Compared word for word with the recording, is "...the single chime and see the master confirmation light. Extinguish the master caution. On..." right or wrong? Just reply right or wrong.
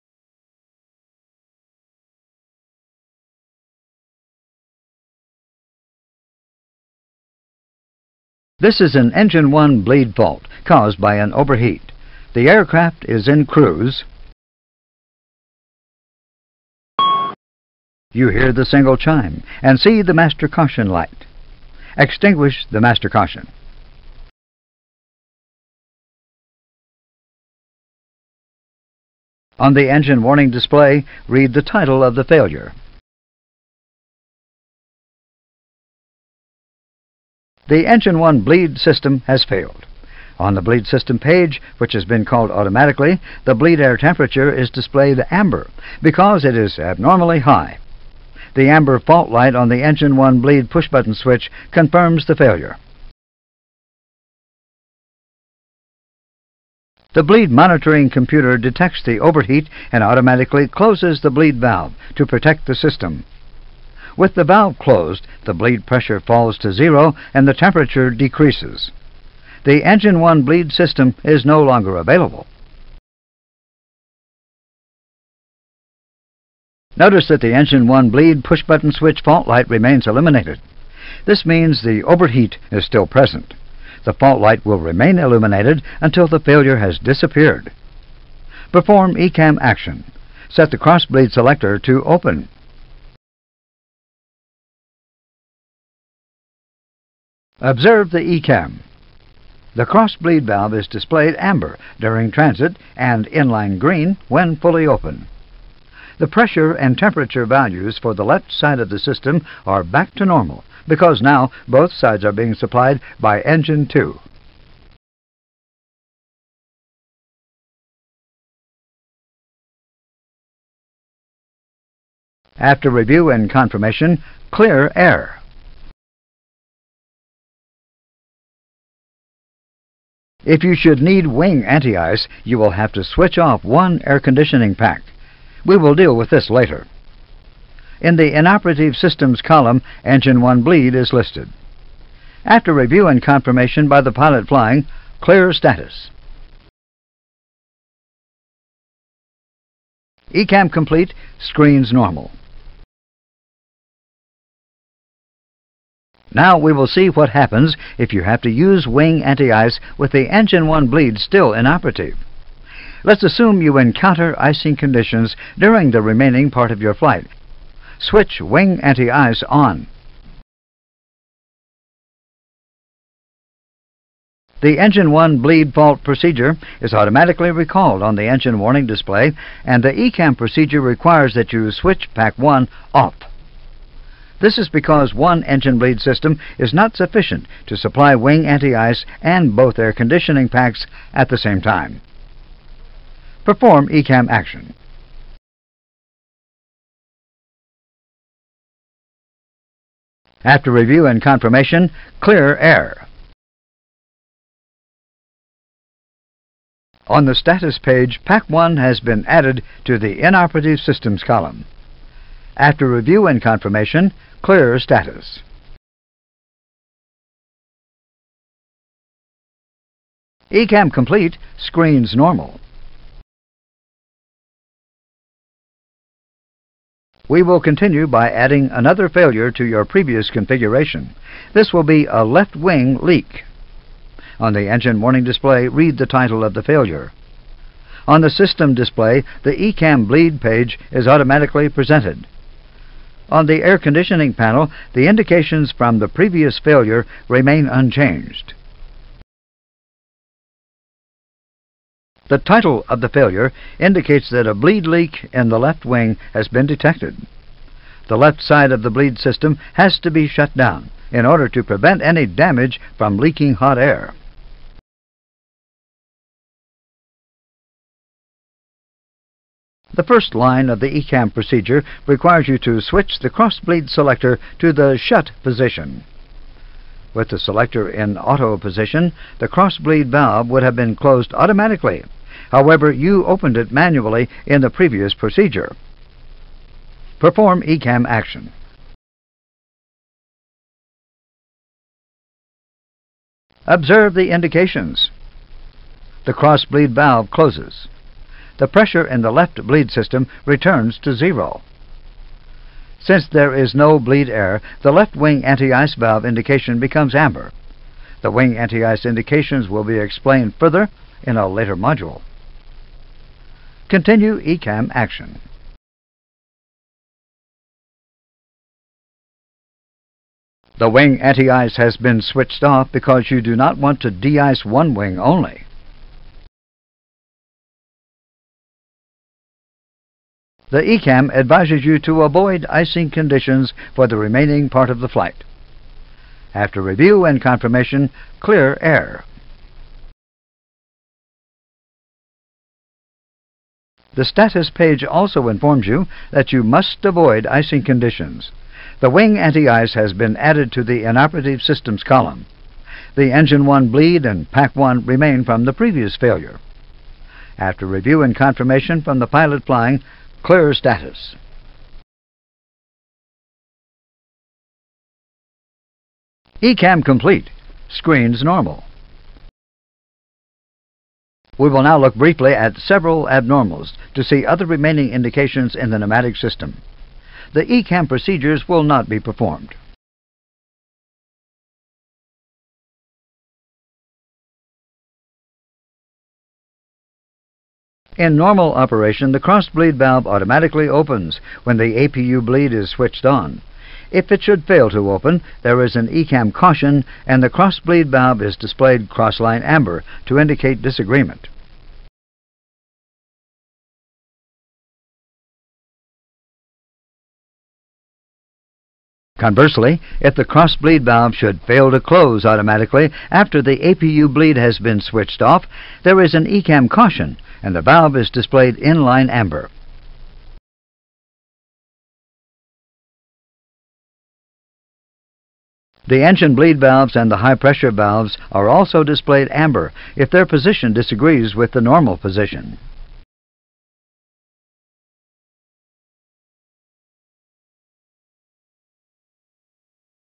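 wrong.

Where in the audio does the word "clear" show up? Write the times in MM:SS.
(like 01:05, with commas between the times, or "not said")
02:04, 02:25, 03:22, 03:34, 05:38, 06:00.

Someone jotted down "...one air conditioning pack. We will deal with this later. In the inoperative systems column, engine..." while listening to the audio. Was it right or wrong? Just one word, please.
right.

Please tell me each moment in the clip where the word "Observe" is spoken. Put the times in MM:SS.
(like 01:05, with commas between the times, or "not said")
01:37, 04:53.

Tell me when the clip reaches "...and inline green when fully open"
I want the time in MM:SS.
01:42.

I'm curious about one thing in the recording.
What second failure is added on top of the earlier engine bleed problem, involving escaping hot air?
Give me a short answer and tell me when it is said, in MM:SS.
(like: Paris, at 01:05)
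Left wing leak, at 03:52.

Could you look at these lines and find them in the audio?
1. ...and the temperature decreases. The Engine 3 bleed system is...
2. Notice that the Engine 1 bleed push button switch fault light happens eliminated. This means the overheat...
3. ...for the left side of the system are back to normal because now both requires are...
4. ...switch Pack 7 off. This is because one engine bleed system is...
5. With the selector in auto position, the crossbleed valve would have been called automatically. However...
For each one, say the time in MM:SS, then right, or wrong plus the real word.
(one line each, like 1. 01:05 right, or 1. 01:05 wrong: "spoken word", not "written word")
1. 01:07 wrong: "1", not "3"
2. 01:16 wrong: "remains", not "happens"
3. 01:48 wrong: "sides", not "requires"
4. 03:01 wrong: "1", not "7"
5. 04:37 wrong: "closed", not "called".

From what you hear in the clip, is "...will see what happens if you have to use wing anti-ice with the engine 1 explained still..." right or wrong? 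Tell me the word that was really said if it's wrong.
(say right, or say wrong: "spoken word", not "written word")
wrong: "bleed", not "explained".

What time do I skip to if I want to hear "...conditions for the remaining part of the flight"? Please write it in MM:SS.
05:33.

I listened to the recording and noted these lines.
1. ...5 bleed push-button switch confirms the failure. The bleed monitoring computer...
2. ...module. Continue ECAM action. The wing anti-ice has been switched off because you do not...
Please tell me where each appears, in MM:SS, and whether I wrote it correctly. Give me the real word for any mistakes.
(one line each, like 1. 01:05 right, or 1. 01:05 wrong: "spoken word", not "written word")
1. 00:50 wrong: "1", not "5"
2. 05:11 right.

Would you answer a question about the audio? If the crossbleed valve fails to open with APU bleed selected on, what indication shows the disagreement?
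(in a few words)
Crossline amber.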